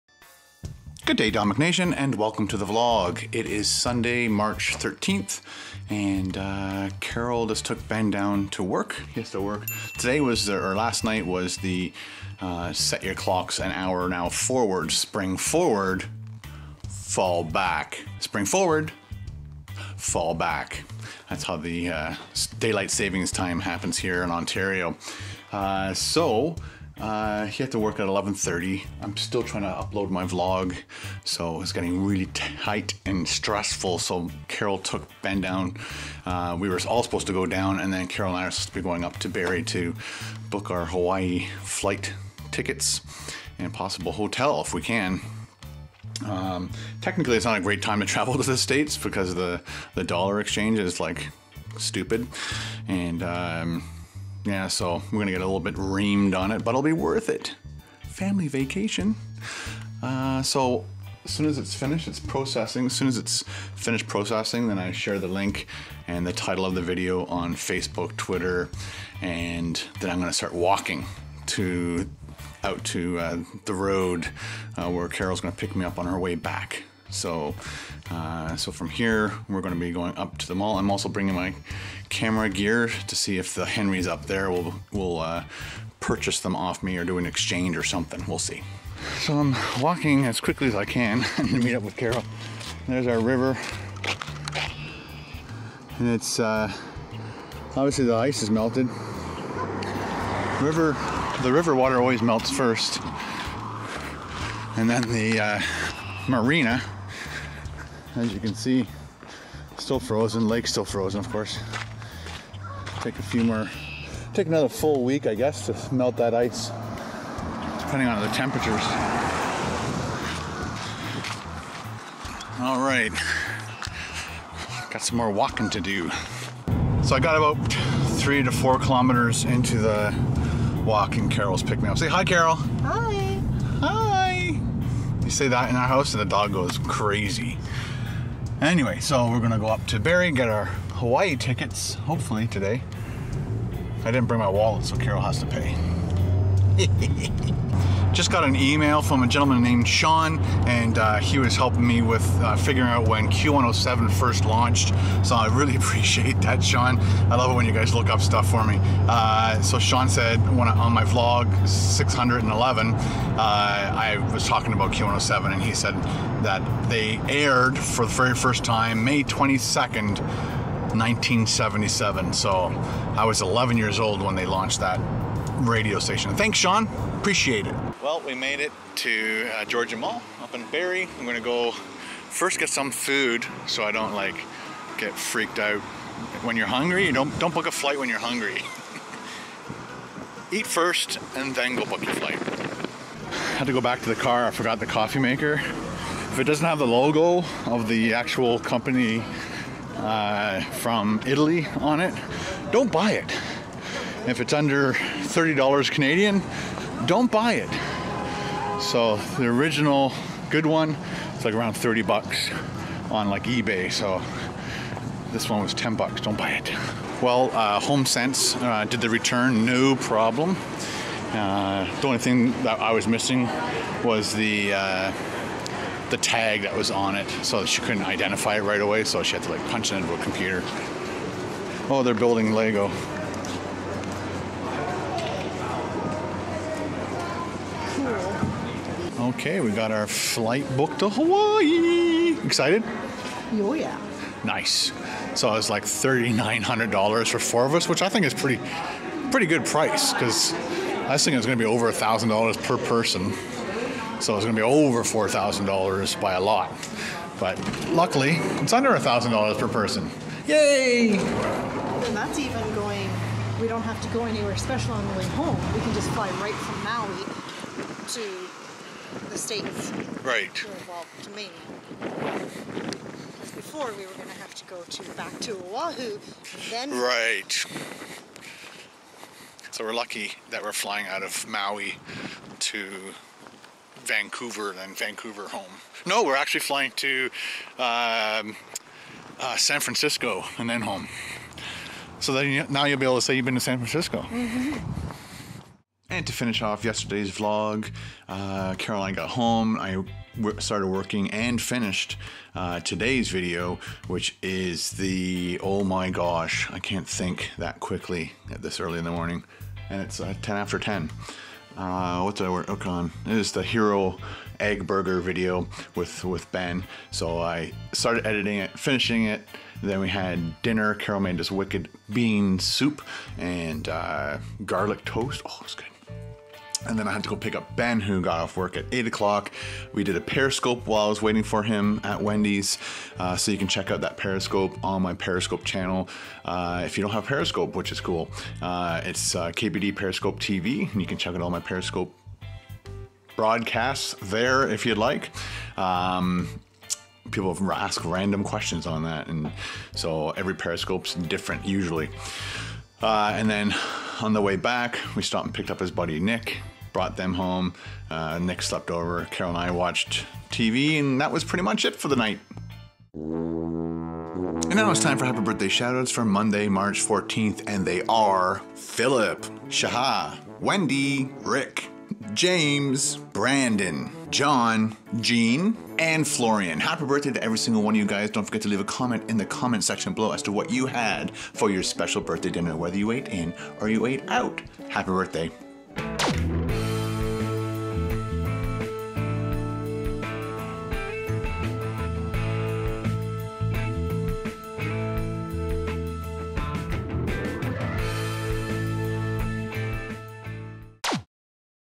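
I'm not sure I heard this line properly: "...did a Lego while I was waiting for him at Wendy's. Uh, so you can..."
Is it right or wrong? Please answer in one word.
wrong.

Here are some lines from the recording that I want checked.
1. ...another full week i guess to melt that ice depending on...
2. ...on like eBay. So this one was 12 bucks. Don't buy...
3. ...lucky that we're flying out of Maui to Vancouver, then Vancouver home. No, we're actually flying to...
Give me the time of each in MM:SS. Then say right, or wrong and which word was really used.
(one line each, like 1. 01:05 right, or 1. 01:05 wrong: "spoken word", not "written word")
1. 01:54 right
2. 03:33 wrong: "10", not "12"
3. 04:39 right.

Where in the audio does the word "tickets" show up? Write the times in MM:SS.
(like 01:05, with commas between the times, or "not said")
00:42, 02:21.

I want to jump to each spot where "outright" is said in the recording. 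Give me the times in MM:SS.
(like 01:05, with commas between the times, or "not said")
not said.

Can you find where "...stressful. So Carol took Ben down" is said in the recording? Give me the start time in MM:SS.
00:33.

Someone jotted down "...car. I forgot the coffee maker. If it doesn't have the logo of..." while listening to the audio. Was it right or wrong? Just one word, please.
right.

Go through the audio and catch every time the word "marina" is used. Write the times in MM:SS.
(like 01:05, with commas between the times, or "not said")
01:46.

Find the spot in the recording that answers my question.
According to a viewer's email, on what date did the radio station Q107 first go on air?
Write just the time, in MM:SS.
02:49.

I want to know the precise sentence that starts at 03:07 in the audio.
You don't don't book a flight when you're hungry.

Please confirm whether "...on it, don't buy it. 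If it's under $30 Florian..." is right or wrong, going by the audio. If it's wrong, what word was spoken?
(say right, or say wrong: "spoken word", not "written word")
wrong: "Canadian", not "Florian".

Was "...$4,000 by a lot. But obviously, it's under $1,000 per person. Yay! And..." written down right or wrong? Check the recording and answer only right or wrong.
wrong.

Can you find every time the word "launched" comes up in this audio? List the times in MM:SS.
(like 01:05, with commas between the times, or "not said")
02:34, 02:54.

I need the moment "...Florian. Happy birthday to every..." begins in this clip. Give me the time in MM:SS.
06:16.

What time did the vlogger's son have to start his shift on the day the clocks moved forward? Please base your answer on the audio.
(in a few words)
11:30.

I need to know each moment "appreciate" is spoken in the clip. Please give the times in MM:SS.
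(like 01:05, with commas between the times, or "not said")
02:35, 02:57.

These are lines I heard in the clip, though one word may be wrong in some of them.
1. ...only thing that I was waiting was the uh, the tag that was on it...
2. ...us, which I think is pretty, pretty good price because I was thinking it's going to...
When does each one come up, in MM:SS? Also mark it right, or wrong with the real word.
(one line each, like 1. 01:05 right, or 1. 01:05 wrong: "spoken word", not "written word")
1. 03:42 wrong: "missing", not "waiting"
2. 04:07 right.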